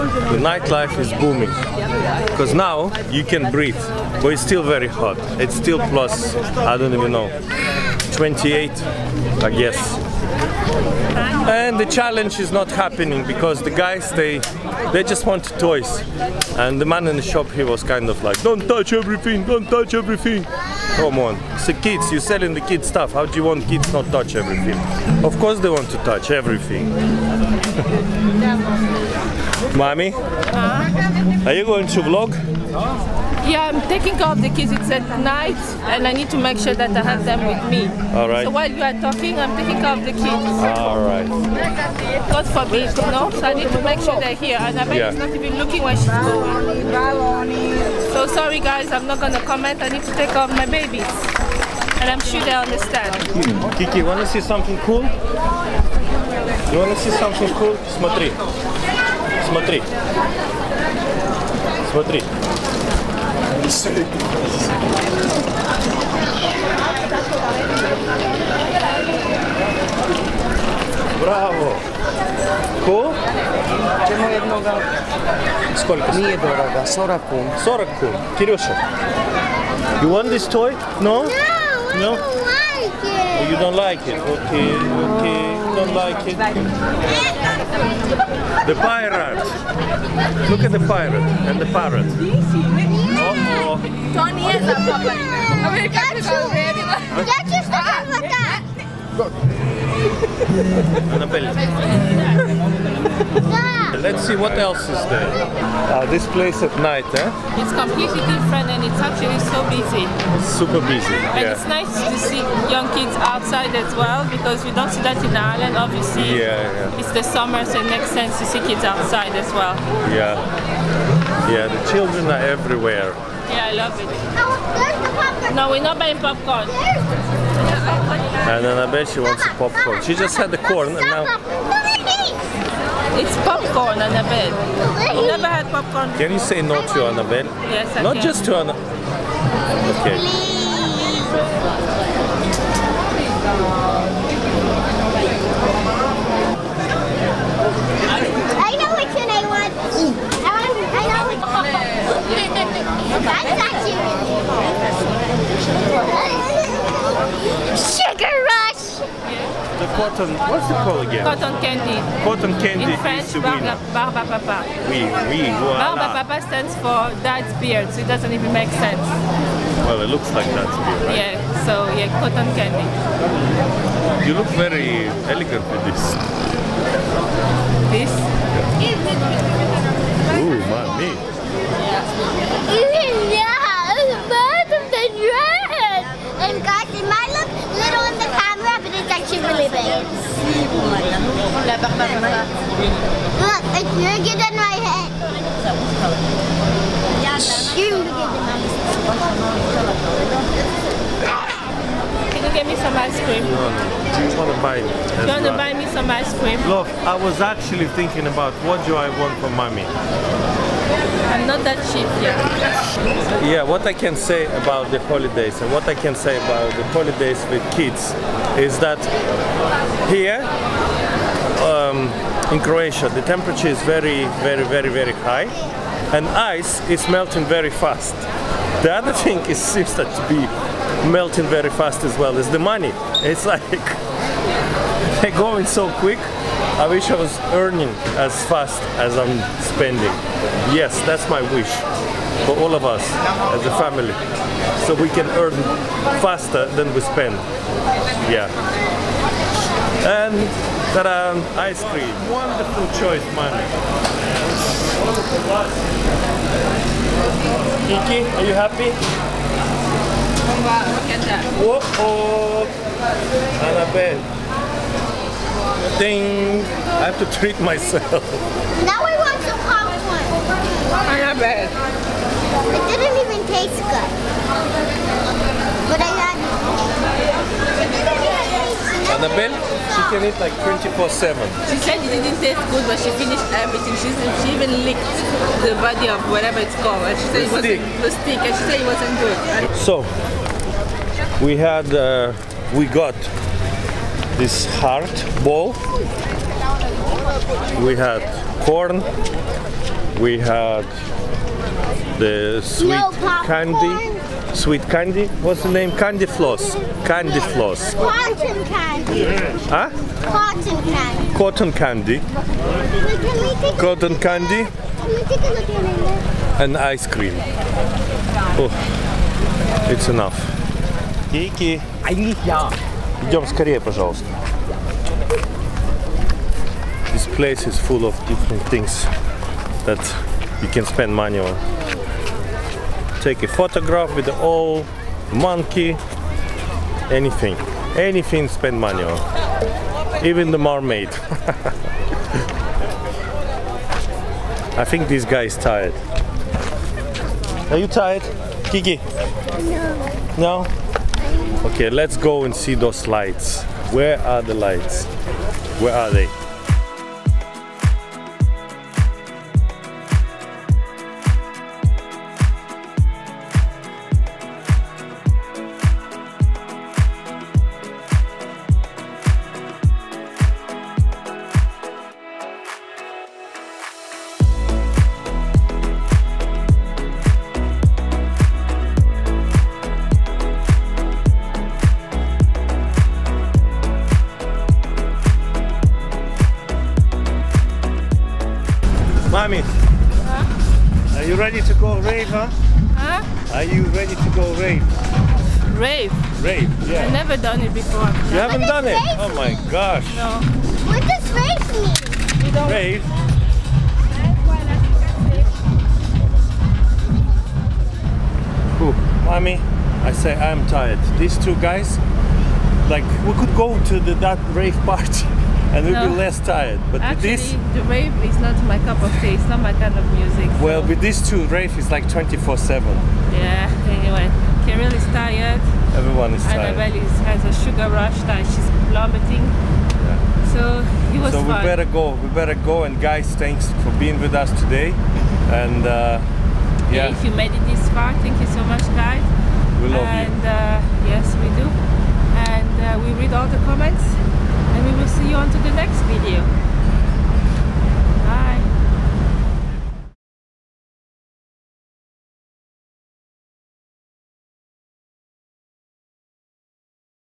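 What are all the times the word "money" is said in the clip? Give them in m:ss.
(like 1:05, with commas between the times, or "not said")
3:52, 5:31, 5:38.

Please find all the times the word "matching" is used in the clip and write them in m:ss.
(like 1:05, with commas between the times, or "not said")
not said.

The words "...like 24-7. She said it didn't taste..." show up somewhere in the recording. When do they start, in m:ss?
4:40.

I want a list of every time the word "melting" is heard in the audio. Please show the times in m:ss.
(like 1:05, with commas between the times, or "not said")
3:47, 3:51.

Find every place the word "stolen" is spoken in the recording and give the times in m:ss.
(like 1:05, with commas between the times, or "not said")
not said.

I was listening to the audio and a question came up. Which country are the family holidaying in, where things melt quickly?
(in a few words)
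Croatia.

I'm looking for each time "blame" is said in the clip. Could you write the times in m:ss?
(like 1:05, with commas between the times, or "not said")
not said.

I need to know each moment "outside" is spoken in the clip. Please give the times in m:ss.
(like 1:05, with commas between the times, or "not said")
1:53, 1:58.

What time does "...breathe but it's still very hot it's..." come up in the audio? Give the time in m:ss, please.
0:03.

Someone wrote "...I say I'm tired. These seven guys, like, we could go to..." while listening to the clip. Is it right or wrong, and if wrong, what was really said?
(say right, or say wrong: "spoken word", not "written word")
wrong: "two", not "seven".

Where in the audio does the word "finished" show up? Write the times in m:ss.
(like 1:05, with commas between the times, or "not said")
4:43.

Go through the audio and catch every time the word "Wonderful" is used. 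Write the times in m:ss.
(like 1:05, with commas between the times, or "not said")
4:12.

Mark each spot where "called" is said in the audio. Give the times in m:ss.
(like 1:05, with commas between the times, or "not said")
2:40, 4:46.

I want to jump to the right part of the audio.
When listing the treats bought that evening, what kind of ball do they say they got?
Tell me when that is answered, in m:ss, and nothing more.
4:54.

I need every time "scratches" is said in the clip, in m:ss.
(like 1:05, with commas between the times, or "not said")
not said.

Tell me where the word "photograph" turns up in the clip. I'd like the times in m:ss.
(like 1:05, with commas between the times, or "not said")
5:33.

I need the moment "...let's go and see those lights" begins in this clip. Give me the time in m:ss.
5:51.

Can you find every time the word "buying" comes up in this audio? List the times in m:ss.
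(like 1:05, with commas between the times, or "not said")
2:05.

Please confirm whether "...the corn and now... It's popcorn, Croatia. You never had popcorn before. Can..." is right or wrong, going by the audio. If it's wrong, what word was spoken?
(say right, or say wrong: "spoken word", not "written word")
wrong: "Annabelle", not "Croatia".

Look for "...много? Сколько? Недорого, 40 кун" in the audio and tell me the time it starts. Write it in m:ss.
1:14.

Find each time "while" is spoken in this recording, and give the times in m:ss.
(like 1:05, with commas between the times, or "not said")
0:38.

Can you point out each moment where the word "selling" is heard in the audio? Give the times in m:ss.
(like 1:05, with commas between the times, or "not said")
0:22.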